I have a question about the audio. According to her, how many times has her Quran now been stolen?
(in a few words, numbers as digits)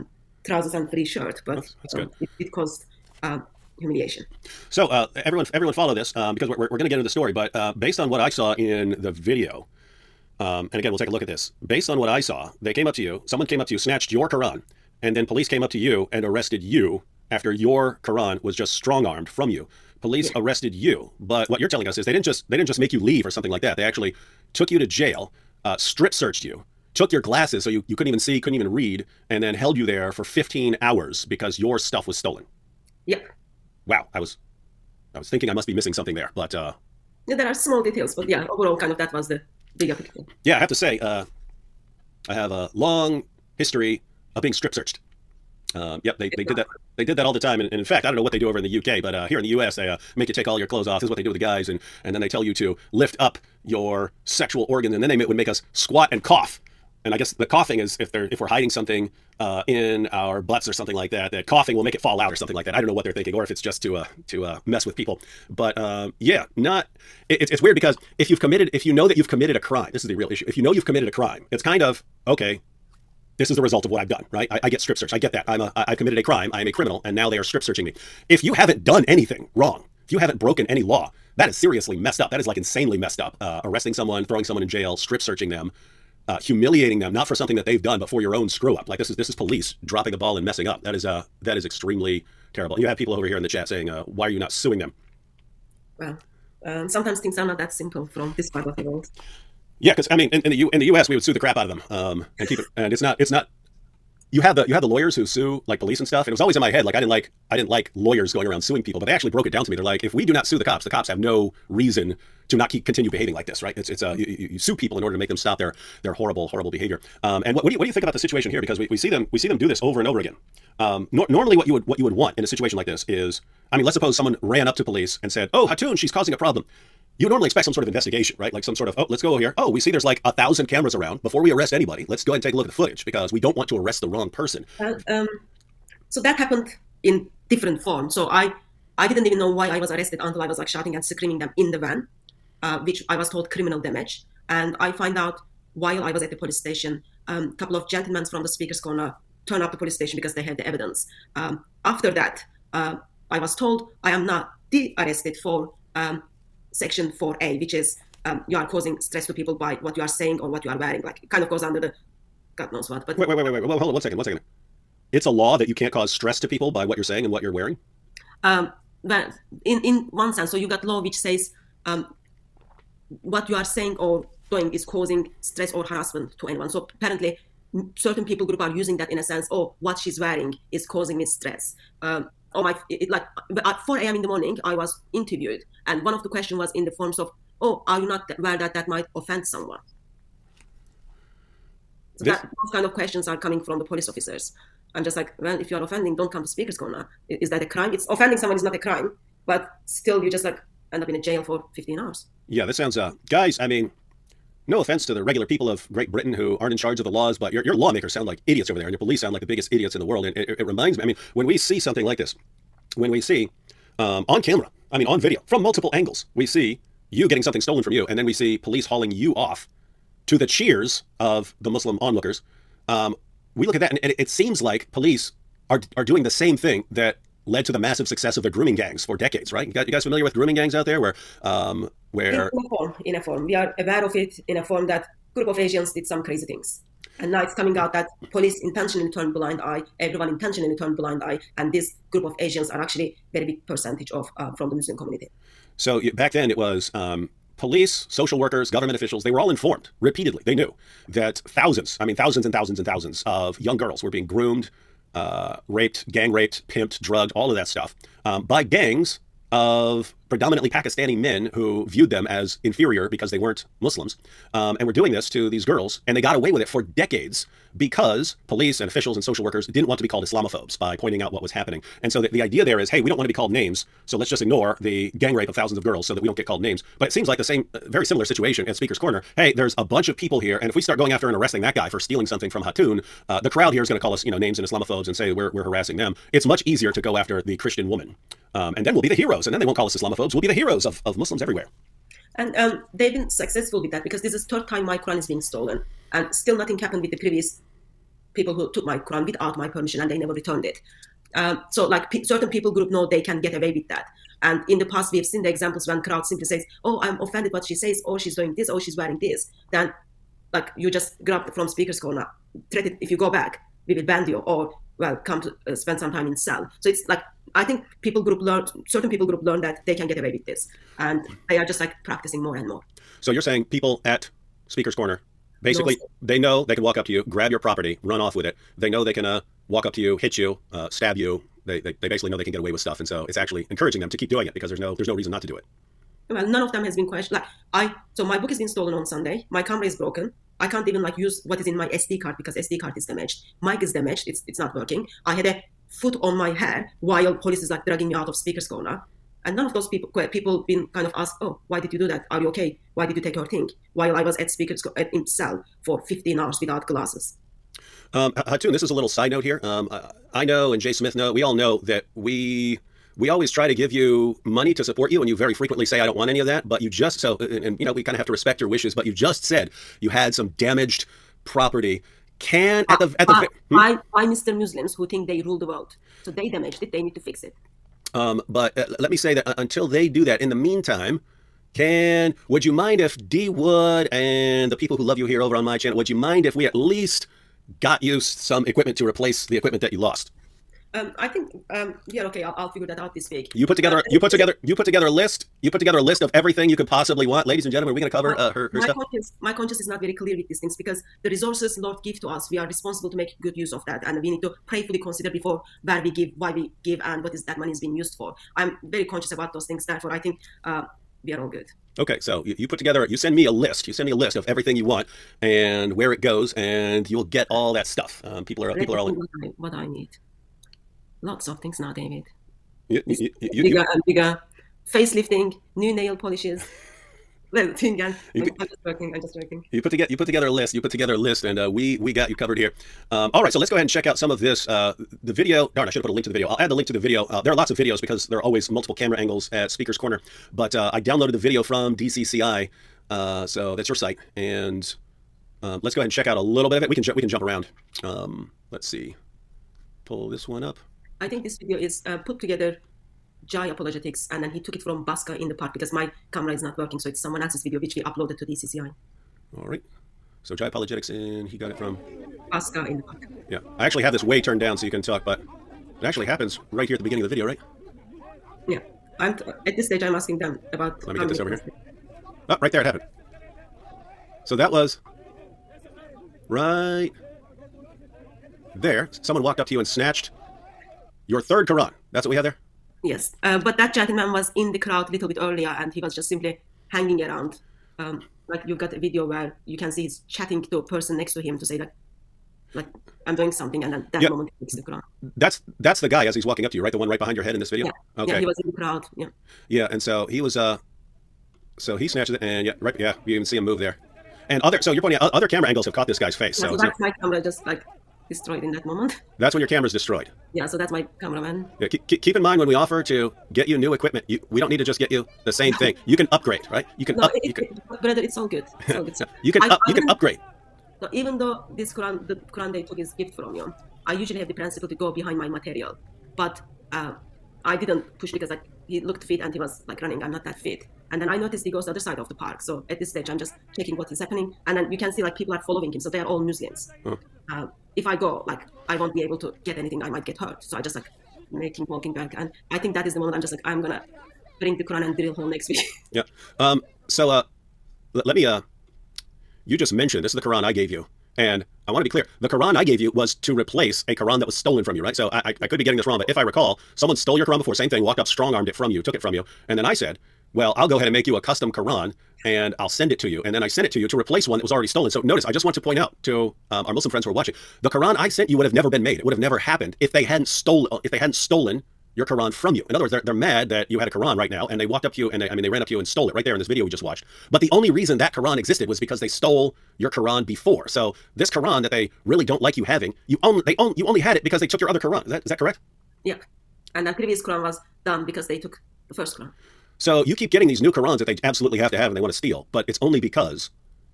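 third time.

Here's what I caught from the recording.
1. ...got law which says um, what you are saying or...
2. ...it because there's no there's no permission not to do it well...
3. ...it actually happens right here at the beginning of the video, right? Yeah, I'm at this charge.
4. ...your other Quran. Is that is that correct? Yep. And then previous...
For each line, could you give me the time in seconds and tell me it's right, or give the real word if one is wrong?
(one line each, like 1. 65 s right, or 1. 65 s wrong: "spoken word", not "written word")
1. 170 s right
2. 334 s wrong: "reason", not "permission"
3. 466 s wrong: "stage", not "charge"
4. 584 s right.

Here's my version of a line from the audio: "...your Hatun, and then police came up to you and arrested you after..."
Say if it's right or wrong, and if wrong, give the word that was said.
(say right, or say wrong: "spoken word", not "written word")
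wrong: "Quran", not "Hatun".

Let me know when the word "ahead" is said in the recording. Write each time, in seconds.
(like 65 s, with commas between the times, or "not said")
132 s, 433 s, 445 s, 560 s.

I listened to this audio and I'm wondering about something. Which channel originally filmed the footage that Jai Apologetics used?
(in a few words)
Oscar in the Park.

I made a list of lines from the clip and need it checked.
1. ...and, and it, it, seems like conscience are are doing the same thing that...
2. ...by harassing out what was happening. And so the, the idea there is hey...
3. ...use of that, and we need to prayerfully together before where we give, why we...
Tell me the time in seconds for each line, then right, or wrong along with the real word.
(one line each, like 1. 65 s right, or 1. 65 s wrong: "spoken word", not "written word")
1. 223 s wrong: "police", not "conscience"
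2. 270 s wrong: "pointing", not "harassing"
3. 403 s wrong: "consider", not "together".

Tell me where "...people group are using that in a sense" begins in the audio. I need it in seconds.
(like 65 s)
178 s.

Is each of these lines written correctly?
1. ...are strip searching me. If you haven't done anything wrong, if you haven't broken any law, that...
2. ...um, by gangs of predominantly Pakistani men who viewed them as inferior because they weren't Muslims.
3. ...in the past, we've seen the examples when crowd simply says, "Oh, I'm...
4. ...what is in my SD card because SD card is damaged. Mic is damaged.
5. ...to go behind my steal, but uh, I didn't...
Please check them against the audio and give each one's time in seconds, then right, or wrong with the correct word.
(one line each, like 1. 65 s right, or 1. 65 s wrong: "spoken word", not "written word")
1. 77 s right
2. 258 s right
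3. 304 s right
4. 341 s right
5. 524 s wrong: "material", not "steal".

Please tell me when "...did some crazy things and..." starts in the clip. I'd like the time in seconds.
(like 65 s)
235 s.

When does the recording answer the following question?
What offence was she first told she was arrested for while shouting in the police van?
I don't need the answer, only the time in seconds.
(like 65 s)
143 s.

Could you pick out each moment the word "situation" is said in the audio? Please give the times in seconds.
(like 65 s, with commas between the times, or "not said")
118 s, 122 s, 278 s.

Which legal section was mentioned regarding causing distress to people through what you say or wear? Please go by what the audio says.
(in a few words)
section 4A.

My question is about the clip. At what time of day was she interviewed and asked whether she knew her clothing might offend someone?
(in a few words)
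4 a.m.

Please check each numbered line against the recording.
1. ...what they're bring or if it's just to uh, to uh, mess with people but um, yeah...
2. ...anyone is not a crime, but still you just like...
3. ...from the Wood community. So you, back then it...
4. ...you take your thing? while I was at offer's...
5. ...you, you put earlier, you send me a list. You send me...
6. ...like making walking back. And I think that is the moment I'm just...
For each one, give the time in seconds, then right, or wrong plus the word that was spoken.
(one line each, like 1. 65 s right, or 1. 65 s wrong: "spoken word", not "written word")
1. 62 s wrong: "thinking", not "bring"
2. 198 s wrong: "someone", not "anyone"
3. 244 s wrong: "Muslim", not "Wood"
4. 353 s wrong: "speaker", not "offer"
5. 412 s wrong: "together", not "earlier"
6. 540 s right.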